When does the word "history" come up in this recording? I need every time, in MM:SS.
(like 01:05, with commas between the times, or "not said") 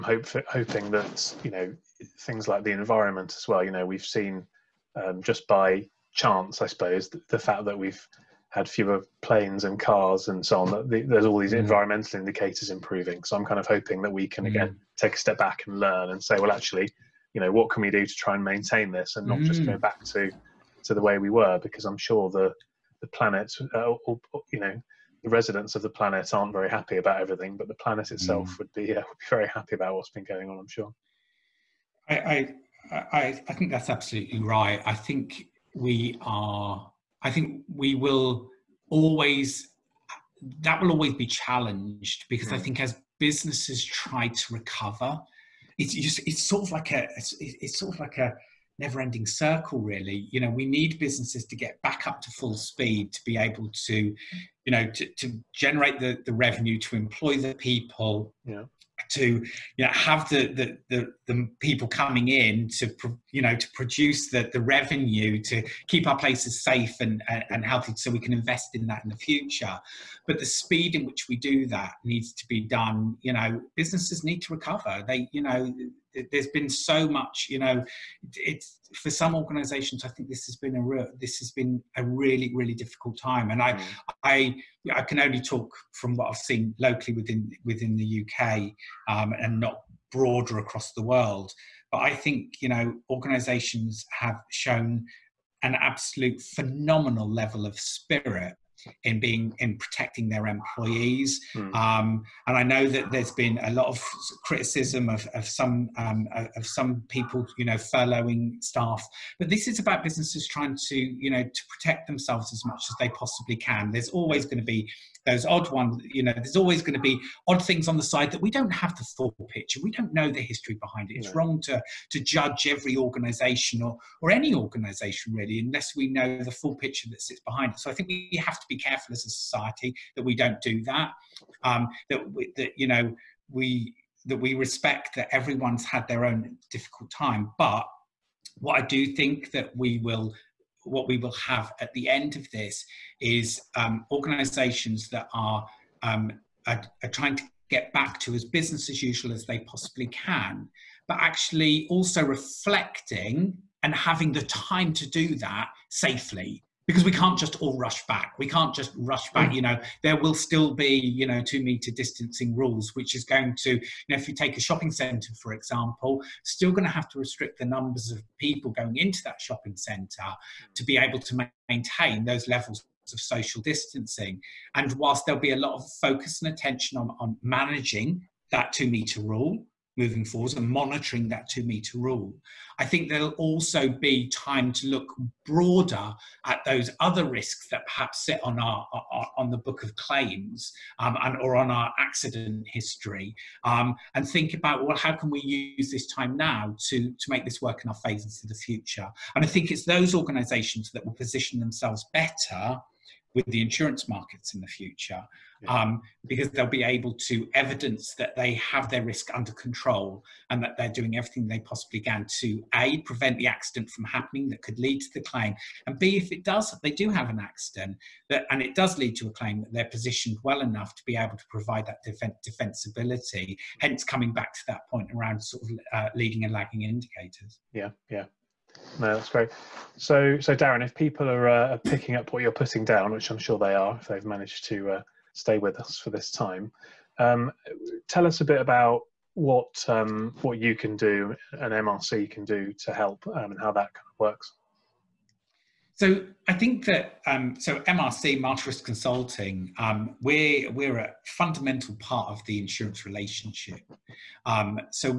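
02:00, 03:12.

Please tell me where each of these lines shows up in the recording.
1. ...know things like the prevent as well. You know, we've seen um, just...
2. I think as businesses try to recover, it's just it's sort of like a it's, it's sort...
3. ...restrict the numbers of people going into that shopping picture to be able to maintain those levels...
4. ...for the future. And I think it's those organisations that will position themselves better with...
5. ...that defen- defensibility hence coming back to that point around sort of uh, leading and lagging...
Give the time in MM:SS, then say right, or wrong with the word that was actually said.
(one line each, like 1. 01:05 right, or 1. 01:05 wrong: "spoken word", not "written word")
1. 00:01 wrong: "environment", not "prevent"
2. 00:42 right
3. 02:47 wrong: "centre", not "picture"
4. 03:18 right
5. 03:41 right.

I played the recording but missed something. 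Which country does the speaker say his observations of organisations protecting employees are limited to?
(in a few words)
UK.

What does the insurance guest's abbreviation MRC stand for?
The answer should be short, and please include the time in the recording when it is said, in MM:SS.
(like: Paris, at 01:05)
Marsh Risk Consulting, at 04:08.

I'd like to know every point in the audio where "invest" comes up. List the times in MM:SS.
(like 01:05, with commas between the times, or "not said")
01:08.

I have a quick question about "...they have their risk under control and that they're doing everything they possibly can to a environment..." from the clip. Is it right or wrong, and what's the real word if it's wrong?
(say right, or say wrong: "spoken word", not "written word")
wrong: "prevent", not "environment".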